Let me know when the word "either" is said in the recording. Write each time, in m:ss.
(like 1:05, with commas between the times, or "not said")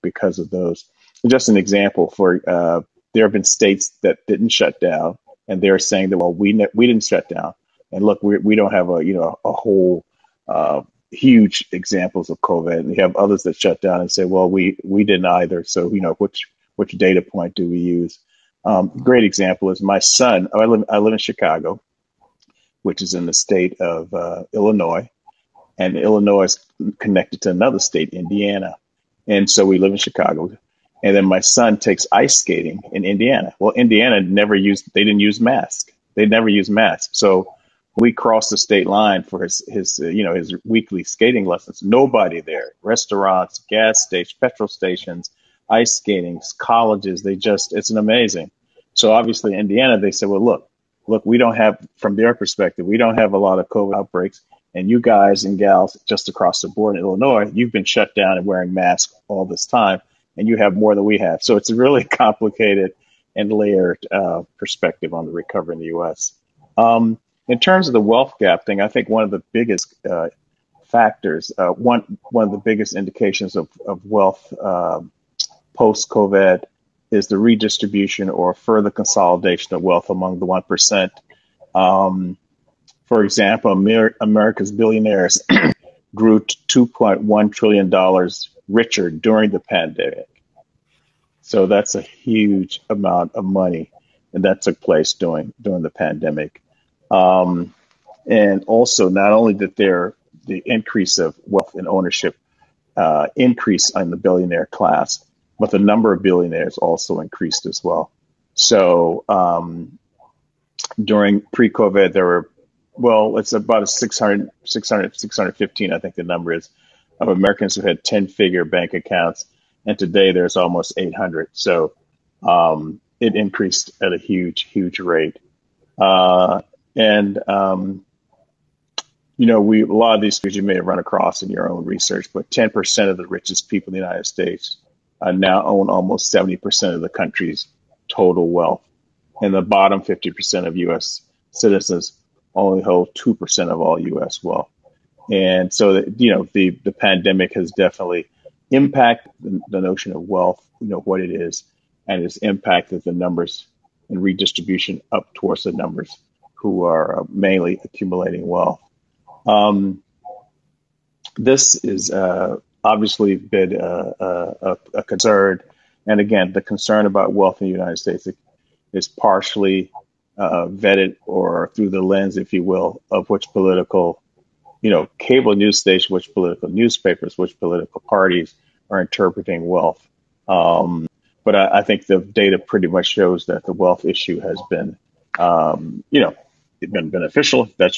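0:15.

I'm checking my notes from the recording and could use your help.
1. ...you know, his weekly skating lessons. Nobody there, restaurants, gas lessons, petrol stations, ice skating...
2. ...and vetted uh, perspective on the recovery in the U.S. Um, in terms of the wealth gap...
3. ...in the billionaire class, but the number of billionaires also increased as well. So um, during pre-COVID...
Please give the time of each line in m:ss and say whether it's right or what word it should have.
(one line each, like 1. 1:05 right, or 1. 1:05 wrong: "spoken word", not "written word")
1. 0:40 wrong: "stations", not "lessons"
2. 1:03 wrong: "layered", not "vetted"
3. 1:43 right.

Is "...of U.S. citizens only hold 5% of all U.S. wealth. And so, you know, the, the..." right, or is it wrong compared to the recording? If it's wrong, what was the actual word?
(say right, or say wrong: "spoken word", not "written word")
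wrong: "2", not "5".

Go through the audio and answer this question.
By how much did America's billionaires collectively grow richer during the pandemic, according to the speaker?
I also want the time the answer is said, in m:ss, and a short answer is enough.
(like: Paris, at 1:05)
$2.1 trillion, at 1:26.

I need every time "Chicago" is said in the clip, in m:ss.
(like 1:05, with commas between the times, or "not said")
0:21, 0:29.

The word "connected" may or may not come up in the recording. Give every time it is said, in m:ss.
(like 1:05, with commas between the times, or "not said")
0:26.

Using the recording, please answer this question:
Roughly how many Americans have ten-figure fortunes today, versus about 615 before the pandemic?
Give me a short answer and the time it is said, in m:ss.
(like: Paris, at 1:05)
almost 800, at 2:00.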